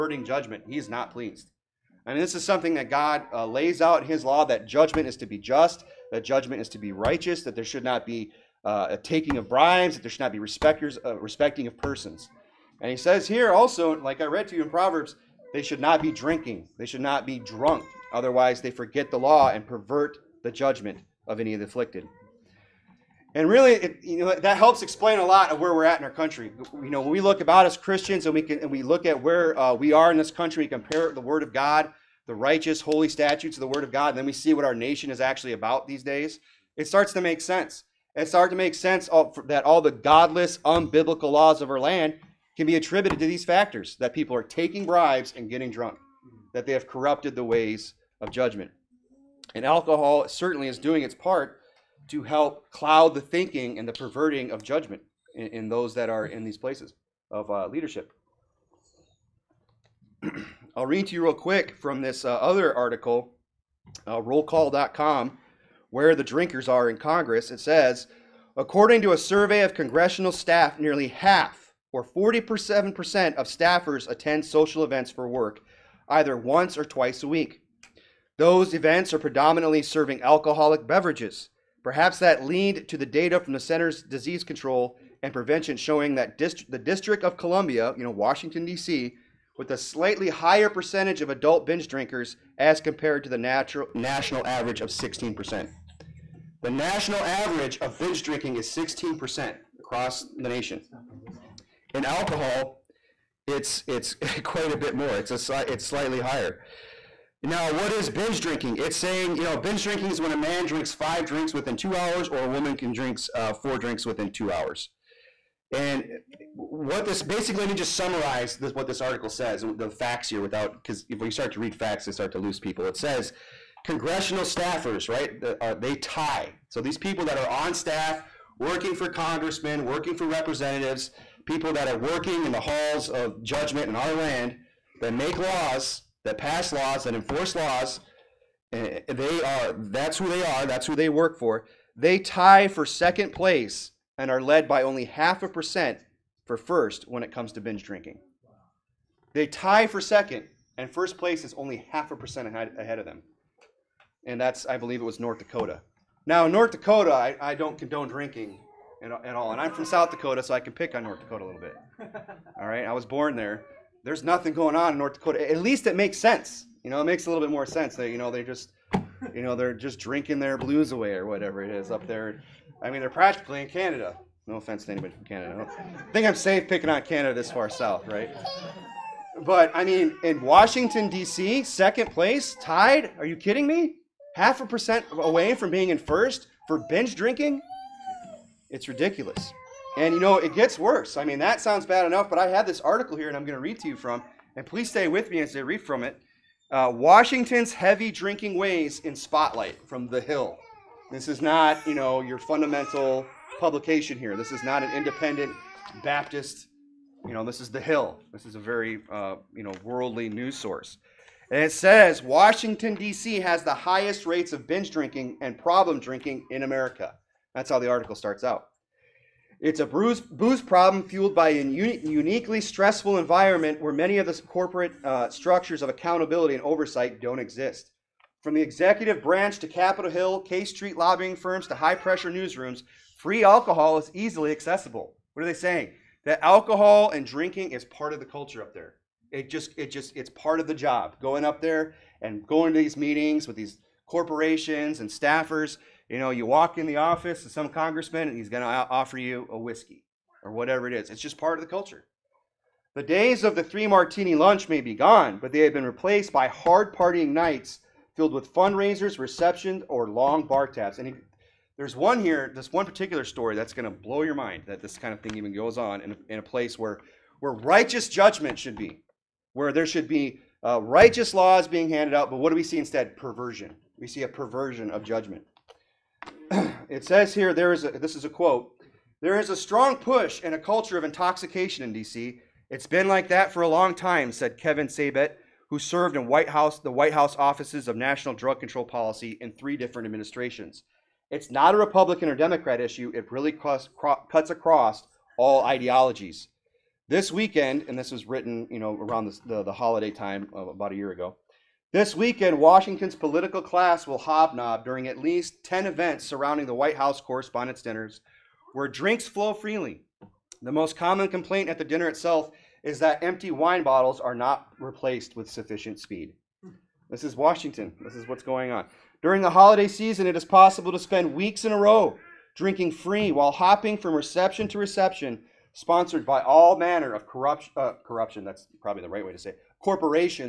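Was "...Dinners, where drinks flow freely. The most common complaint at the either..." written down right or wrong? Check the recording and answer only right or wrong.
wrong.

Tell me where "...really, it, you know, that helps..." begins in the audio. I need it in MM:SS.
00:23.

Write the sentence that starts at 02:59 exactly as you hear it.
But I mean, in Washington D.C., second place, tied.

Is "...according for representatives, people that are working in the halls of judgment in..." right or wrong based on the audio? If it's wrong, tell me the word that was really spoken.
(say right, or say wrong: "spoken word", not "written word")
wrong: "working", not "according".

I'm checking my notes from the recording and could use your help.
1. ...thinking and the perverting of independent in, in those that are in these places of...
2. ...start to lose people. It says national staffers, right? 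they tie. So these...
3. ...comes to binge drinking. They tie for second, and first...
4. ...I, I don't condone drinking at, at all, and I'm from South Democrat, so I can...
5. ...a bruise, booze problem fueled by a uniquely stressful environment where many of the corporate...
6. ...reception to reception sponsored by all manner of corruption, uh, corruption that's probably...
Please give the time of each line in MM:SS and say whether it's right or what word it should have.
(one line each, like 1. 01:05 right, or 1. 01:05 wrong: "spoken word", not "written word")
1. 00:53 wrong: "judgment", not "independent"
2. 02:02 wrong: "congressional", not "national"
3. 02:27 right
4. 02:37 wrong: "Dakota", not "Democrat"
5. 03:39 right
6. 05:24 right.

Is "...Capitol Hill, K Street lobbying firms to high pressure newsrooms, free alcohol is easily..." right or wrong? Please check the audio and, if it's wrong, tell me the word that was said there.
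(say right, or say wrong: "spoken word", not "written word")
right.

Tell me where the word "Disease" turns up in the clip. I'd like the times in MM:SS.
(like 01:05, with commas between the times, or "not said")
01:24.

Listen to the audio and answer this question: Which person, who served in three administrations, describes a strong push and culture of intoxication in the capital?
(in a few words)
Kevin Sabet.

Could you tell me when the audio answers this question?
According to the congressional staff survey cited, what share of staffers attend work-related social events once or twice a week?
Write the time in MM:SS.
01:12.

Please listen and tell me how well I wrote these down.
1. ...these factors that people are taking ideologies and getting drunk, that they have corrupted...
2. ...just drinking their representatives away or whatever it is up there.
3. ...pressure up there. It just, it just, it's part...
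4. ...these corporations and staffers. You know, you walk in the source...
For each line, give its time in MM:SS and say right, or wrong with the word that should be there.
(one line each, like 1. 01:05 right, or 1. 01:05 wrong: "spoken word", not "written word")
1. 00:43 wrong: "bribes", not "ideologies"
2. 02:49 wrong: "blues", not "representatives"
3. 03:58 wrong: "culture", not "pressure"
4. 04:03 wrong: "office", not "source".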